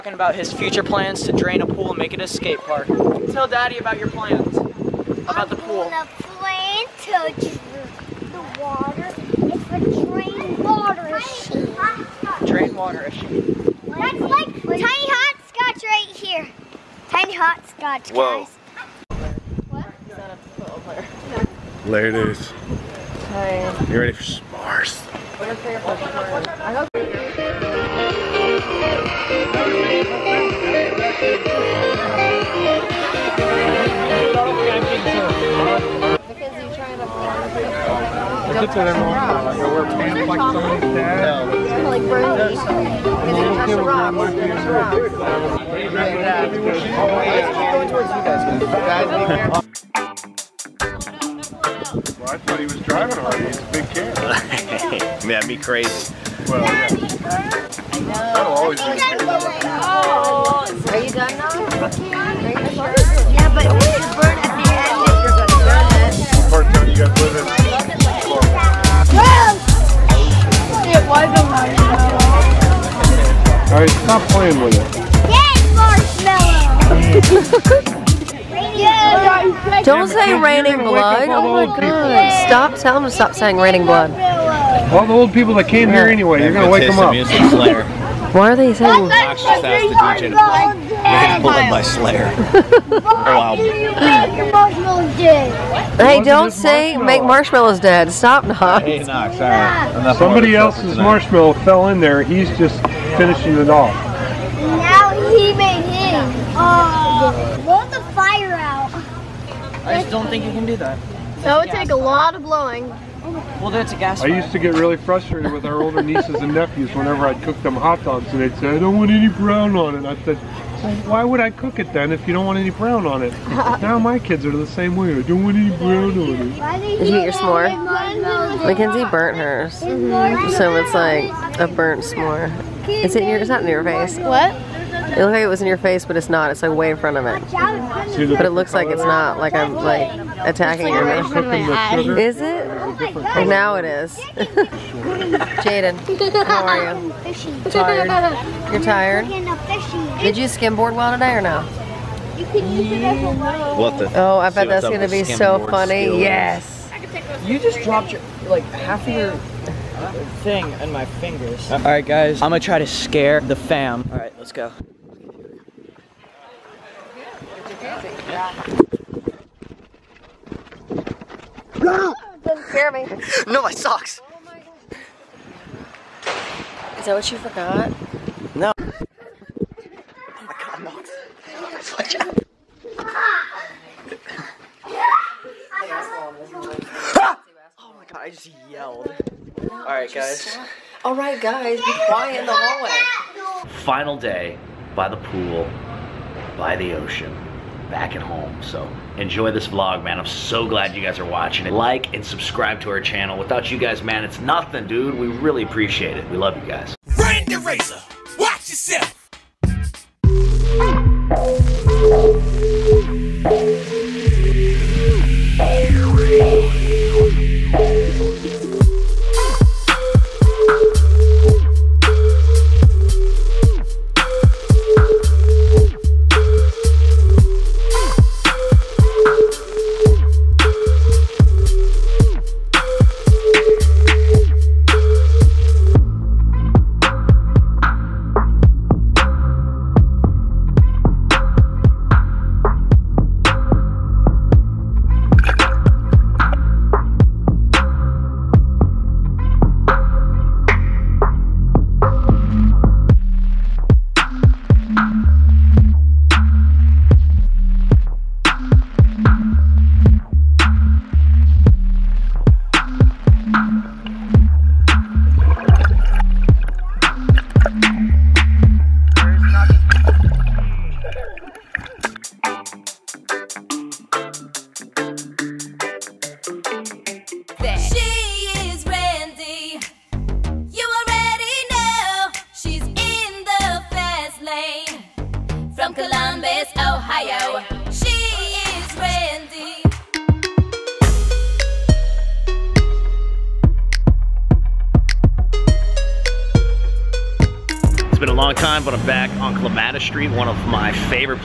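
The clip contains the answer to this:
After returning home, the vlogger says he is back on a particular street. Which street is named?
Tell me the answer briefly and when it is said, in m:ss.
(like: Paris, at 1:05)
Clematis Street, at 4:59.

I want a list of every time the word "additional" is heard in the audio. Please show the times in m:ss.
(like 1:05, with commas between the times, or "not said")
not said.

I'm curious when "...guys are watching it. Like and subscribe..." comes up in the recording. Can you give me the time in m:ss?
3:21.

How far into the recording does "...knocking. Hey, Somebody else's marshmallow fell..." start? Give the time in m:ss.
1:38.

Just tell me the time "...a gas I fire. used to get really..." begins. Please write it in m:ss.
1:53.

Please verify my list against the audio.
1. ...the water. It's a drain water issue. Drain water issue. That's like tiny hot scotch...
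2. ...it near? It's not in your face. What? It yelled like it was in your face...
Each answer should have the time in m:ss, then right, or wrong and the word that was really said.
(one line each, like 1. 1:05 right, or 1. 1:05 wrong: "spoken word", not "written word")
1. 0:08 right
2. 2:13 wrong: "looked", not "yelled".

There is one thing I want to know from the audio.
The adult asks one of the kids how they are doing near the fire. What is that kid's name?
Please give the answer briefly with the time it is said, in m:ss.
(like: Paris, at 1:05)
Jaden, at 2:25.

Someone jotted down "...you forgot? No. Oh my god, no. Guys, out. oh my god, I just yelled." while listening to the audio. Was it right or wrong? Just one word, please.
right.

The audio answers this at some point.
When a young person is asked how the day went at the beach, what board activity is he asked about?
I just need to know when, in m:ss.
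2:30.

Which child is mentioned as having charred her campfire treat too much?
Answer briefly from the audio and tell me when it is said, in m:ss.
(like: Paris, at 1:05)
Mackenzie, at 2:08.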